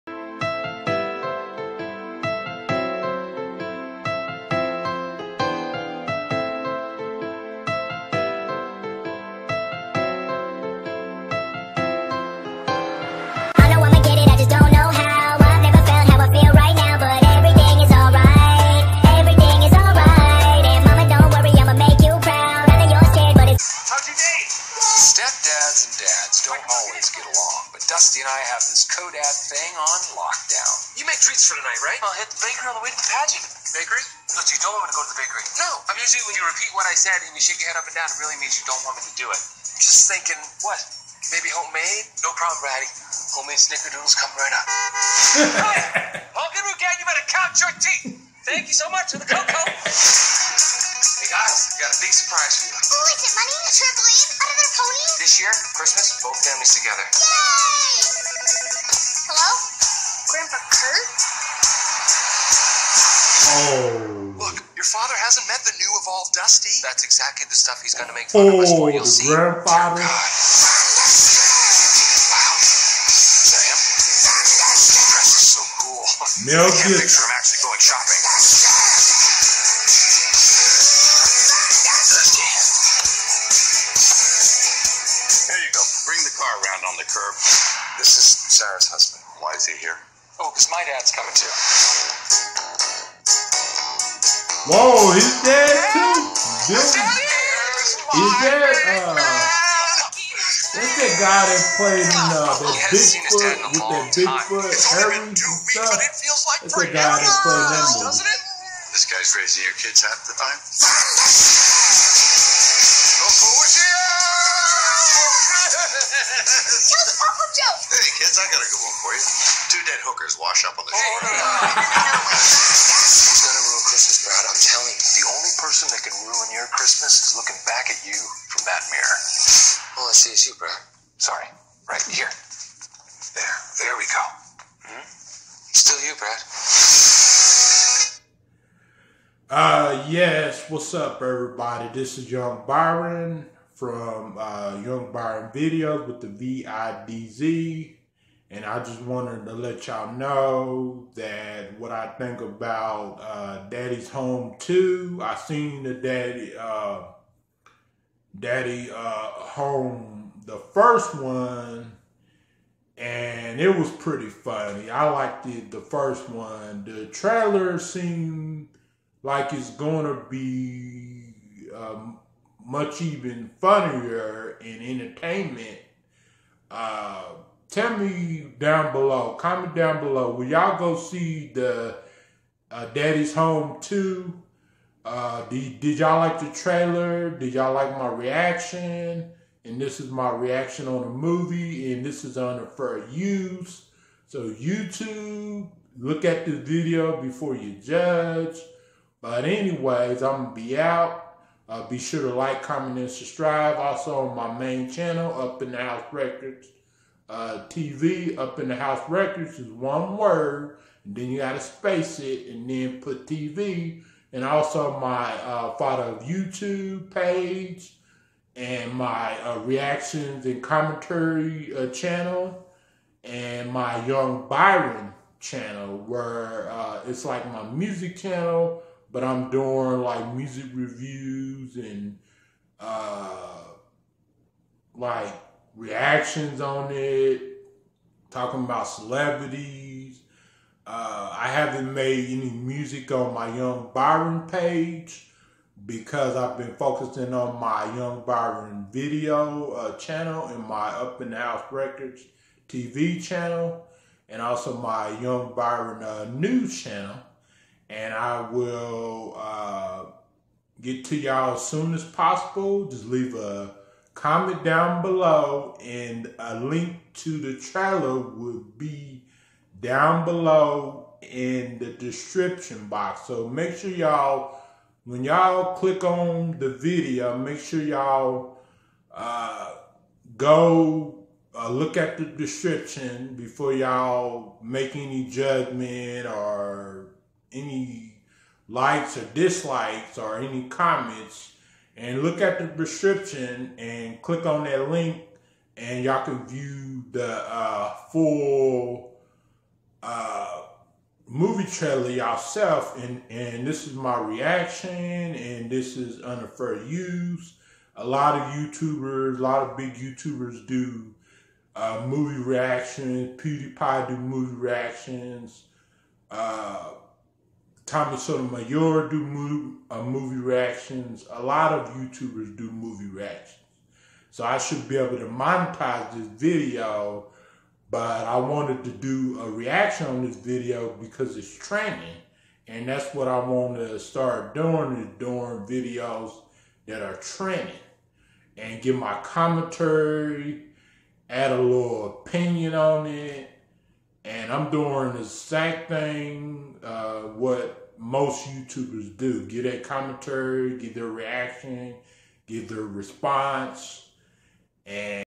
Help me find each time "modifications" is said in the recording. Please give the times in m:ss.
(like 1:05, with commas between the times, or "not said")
not said.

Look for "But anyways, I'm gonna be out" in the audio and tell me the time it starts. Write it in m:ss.
3:19.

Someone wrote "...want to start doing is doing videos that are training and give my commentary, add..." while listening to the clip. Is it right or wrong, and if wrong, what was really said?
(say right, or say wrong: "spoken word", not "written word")
right.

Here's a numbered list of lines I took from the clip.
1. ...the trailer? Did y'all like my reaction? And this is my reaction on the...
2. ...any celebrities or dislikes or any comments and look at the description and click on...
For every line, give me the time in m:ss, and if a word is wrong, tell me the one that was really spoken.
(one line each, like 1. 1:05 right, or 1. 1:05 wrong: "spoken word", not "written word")
1. 3:06 right
2. 4:47 wrong: "likes", not "celebrities".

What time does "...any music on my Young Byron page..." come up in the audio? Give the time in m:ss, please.
4:02.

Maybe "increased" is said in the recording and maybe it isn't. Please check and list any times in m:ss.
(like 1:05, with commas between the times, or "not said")
not said.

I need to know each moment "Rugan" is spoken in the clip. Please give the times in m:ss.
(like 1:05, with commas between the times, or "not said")
0:46.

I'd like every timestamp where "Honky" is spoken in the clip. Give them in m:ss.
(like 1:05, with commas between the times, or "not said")
0:46.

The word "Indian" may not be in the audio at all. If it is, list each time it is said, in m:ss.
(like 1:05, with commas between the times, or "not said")
not said.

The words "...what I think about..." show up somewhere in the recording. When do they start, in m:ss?
2:31.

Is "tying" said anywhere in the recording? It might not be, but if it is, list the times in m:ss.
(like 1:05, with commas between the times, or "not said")
not said.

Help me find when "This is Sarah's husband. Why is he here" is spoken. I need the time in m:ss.
1:27.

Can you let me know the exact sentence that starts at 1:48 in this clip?
This guy's raising your kids half the time.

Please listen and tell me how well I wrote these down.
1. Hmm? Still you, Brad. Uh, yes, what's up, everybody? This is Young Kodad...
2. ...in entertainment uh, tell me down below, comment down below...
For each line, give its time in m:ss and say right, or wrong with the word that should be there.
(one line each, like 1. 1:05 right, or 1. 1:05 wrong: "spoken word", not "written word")
1. 2:14 wrong: "Byron", not "Kodad"
2. 2:54 right.